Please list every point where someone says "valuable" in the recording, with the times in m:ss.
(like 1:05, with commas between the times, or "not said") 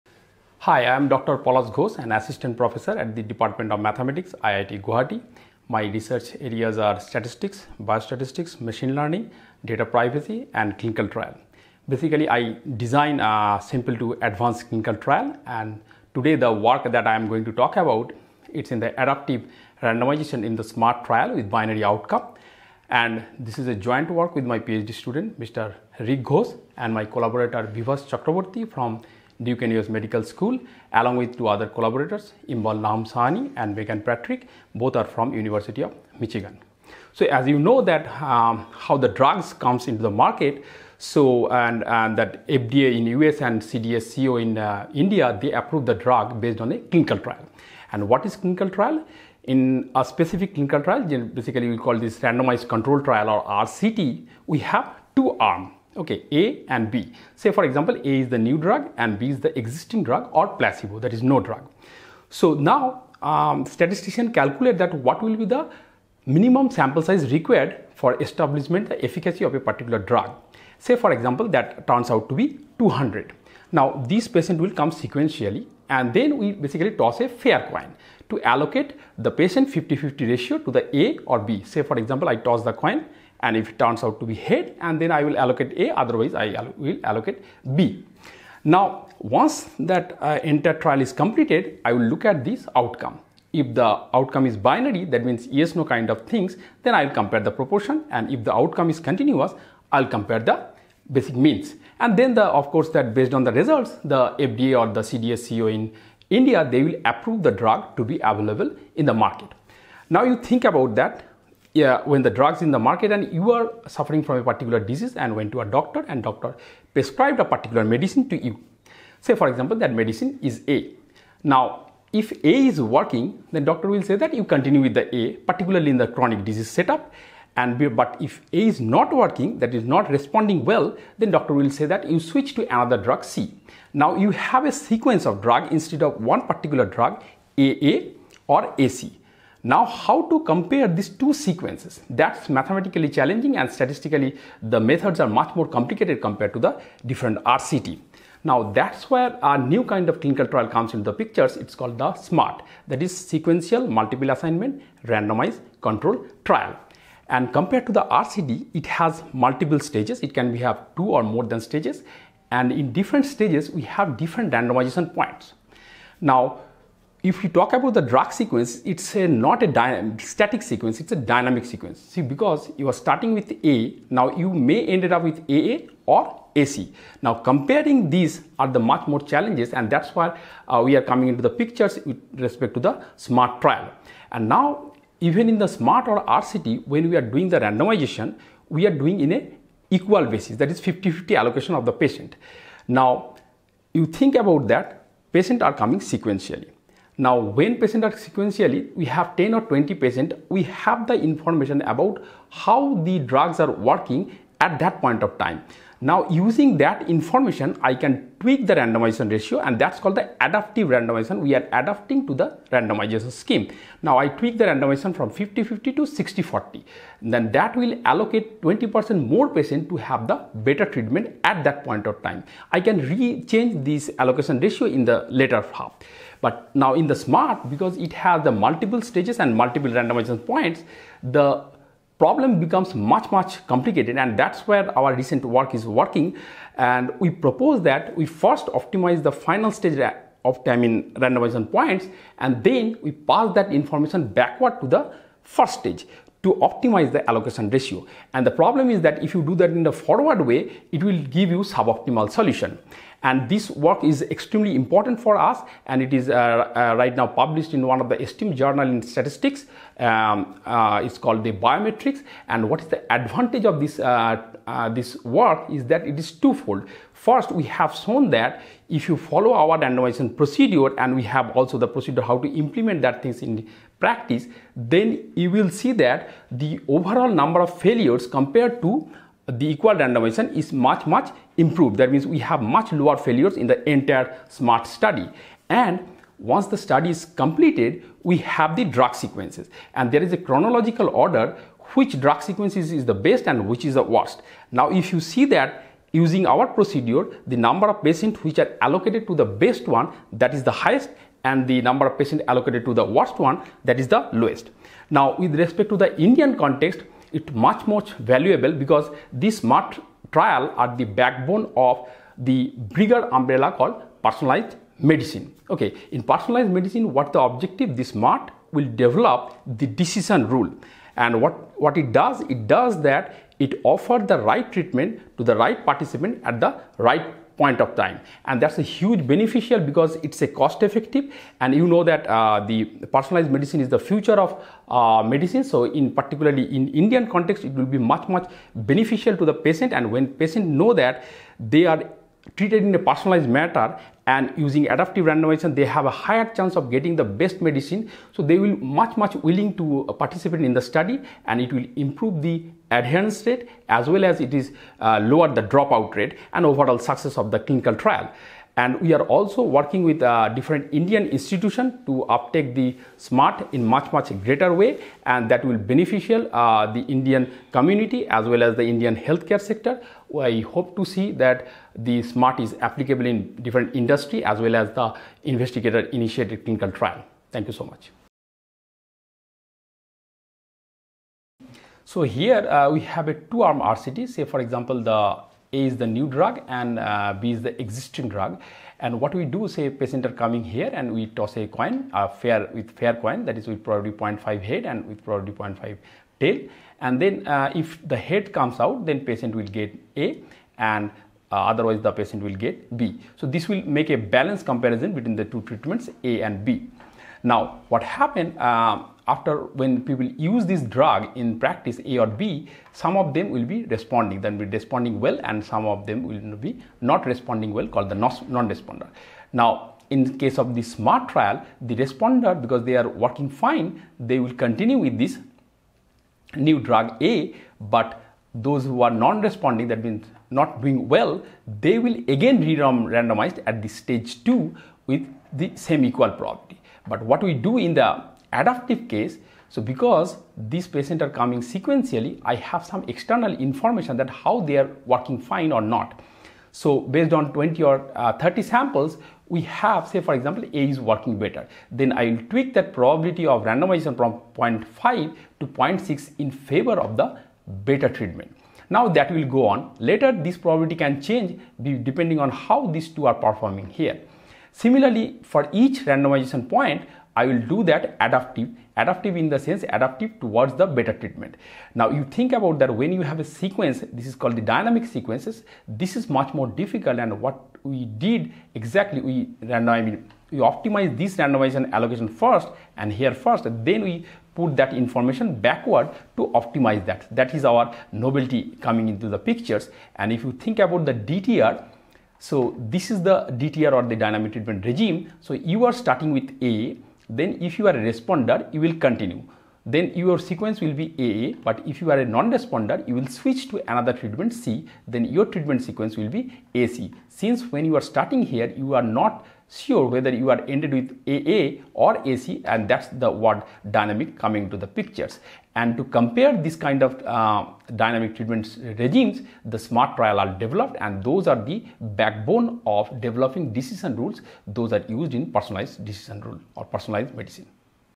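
5:08.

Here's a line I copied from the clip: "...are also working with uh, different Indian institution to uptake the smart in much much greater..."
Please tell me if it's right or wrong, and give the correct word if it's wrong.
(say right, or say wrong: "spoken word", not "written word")
right.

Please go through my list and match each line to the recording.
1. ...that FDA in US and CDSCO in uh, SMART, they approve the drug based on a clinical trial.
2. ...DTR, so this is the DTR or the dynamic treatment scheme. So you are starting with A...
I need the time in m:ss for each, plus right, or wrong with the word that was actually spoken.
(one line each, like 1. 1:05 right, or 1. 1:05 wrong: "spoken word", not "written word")
1. 0:42 wrong: "India", not "SMART"
2. 8:11 wrong: "regime", not "scheme".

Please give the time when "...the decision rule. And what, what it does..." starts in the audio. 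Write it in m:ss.
5:19.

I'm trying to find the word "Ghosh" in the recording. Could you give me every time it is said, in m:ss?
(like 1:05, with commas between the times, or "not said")
0:01, 0:26.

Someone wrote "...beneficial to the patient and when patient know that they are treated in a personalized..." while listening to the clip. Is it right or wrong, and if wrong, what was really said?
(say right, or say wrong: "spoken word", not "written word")
right.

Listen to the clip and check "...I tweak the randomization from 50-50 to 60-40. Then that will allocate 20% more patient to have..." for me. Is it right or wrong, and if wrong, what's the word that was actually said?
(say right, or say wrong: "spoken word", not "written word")
right.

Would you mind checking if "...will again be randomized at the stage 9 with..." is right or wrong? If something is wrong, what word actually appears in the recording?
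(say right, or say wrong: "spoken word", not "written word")
wrong: "2", not "9".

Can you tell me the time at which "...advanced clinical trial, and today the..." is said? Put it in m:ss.
0:14.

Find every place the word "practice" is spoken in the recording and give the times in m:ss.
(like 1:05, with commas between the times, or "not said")
4:33, 6:51.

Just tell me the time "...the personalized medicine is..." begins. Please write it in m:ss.
5:32.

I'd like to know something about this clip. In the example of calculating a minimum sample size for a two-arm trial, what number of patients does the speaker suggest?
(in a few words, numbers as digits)
200.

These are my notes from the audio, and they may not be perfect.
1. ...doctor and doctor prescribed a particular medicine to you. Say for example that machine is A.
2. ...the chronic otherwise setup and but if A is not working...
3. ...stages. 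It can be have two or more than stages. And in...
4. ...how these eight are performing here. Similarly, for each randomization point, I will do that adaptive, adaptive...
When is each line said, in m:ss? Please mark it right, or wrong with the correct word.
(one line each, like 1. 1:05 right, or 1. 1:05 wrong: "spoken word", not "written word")
1. 1:55 wrong: "medicine", not "machine"
2. 2:05 wrong: "disease", not "otherwise"
3. 2:39 right
4. 7:42 wrong: "two", not "eight".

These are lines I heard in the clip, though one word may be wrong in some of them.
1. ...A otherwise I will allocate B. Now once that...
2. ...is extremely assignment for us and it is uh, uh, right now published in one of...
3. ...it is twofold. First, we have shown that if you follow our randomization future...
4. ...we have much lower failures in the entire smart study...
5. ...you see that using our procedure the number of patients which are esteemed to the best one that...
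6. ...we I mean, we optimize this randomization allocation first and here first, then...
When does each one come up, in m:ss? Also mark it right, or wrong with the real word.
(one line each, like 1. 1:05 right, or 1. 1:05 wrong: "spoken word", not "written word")
1. 1:25 right
2. 4:14 wrong: "important", not "assignment"
3. 4:26 wrong: "procedure", not "future"
4. 4:42 right
5. 4:55 wrong: "allocated", not "esteemed"
6. 7:59 right.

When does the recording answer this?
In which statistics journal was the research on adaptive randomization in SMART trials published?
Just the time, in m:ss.
4:21.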